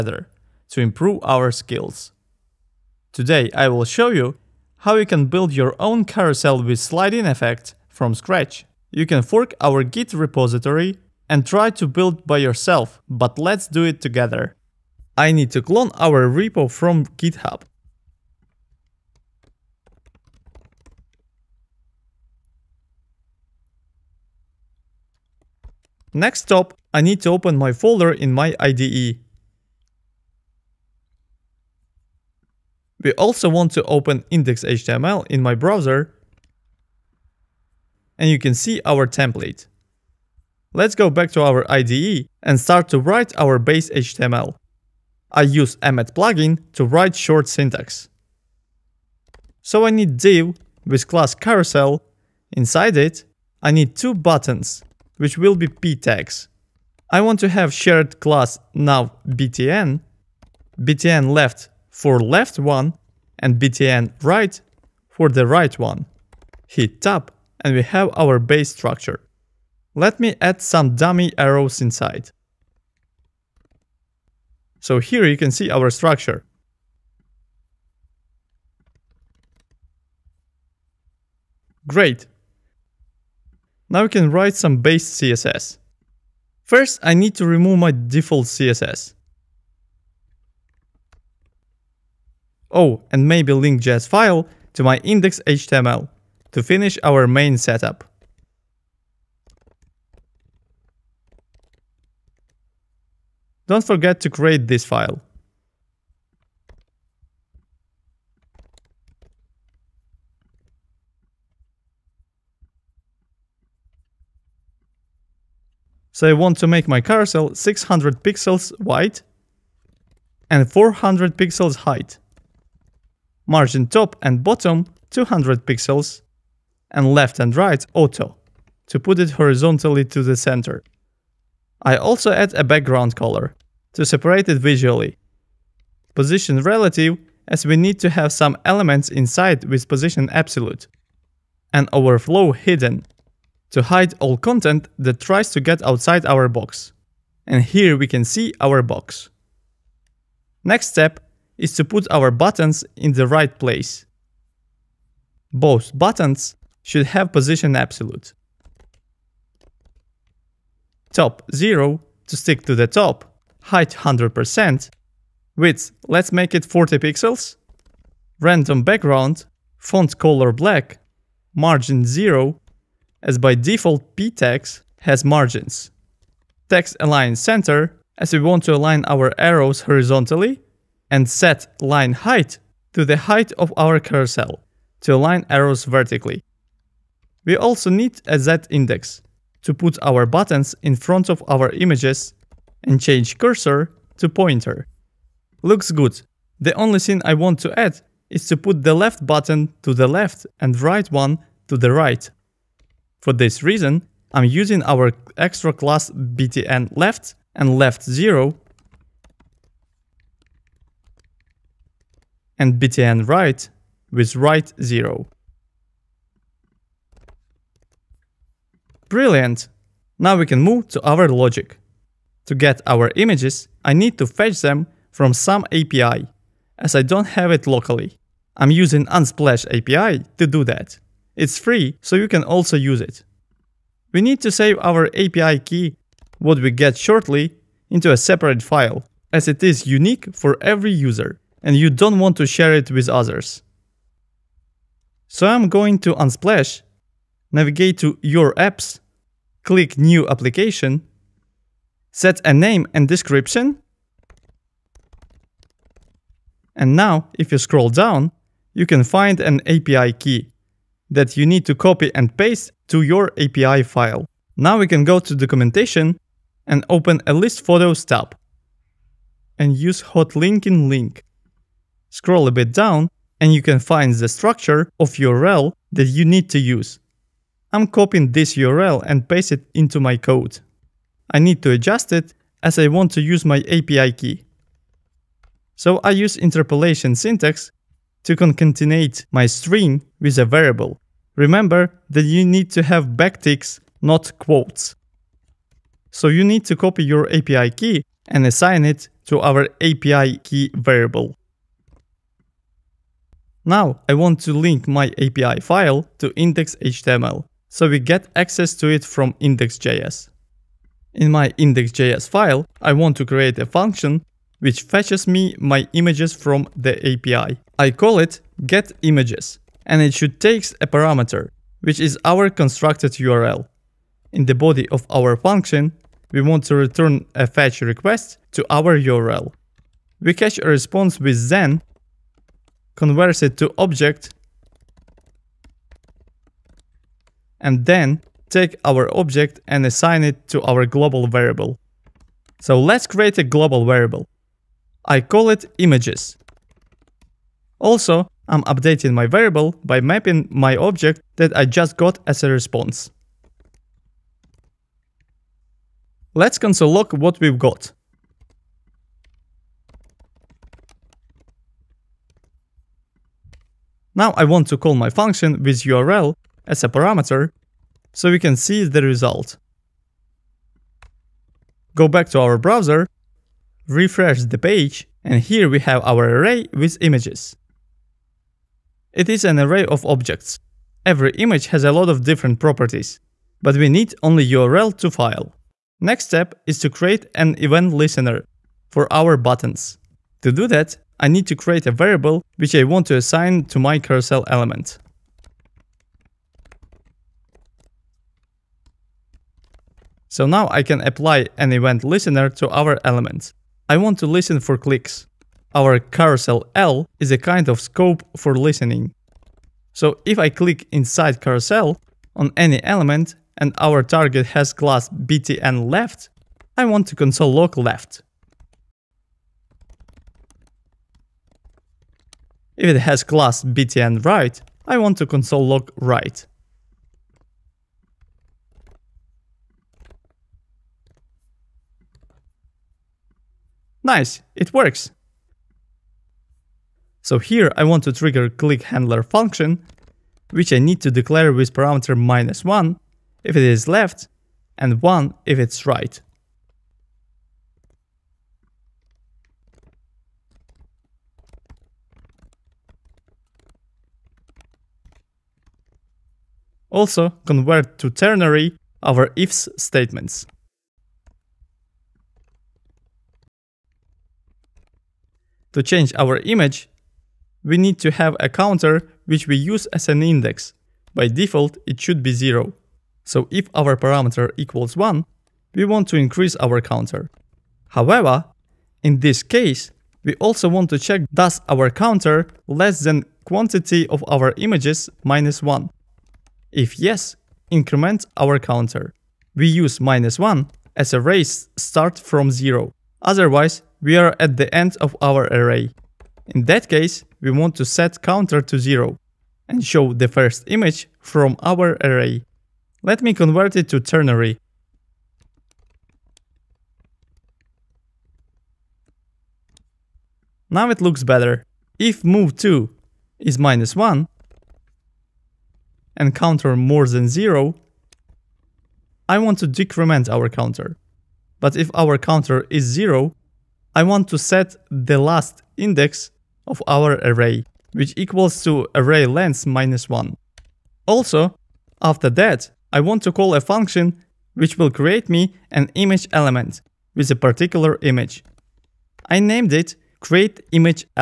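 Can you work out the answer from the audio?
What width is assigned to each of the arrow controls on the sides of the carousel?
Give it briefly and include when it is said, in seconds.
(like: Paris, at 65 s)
40 pixels, at 166 s.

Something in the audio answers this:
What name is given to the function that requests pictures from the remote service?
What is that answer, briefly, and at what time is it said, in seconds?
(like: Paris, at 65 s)
getImages, at 318 s.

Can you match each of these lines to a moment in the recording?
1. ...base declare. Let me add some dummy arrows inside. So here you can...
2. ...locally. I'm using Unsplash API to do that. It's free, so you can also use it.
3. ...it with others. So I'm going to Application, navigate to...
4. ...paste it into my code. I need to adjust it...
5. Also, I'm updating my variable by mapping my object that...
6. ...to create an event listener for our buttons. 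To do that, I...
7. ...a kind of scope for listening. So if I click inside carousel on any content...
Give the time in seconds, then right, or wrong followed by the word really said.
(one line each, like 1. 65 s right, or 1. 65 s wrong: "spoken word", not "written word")
1. 68 s wrong: "structure", not "declare"
2. 227 s right
3. 242 s wrong: "Unsplash", not "Application"
4. 279 s right
5. 347 s right
6. 386 s right
7. 407 s wrong: "element", not "content".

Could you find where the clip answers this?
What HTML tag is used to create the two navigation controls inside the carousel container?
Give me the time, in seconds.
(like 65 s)
55 s.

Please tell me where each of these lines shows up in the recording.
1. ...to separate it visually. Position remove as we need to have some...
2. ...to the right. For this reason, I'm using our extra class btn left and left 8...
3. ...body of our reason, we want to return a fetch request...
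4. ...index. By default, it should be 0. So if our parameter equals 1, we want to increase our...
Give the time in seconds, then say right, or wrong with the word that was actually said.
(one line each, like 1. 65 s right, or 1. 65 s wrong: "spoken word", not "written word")
1. 133 s wrong: "relative", not "remove"
2. 201 s wrong: "0", not "8"
3. 324 s wrong: "function", not "reason"
4. 470 s right.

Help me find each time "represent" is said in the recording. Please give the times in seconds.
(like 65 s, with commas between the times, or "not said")
not said.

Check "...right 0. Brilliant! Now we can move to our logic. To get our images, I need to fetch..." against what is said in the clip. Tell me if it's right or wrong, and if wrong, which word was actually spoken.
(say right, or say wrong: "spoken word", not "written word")
right.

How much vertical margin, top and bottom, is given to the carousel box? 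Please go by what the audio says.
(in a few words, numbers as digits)
200 pixels.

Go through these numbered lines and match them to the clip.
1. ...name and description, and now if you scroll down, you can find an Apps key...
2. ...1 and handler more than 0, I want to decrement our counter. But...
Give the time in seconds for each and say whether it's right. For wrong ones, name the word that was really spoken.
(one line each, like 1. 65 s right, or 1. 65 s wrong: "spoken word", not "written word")
1. 252 s wrong: "API", not "Apps"
2. 513 s wrong: "counter", not "handler".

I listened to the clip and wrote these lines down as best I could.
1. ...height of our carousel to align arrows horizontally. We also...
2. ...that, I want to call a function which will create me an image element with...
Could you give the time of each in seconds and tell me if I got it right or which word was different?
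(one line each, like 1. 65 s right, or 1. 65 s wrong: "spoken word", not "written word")
1. 183 s wrong: "vertically", not "horizontally"
2. 532 s right.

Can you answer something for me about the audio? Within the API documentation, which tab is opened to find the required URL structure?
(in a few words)
list photos.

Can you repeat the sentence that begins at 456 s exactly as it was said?
Also convert to ternary our ifs statements.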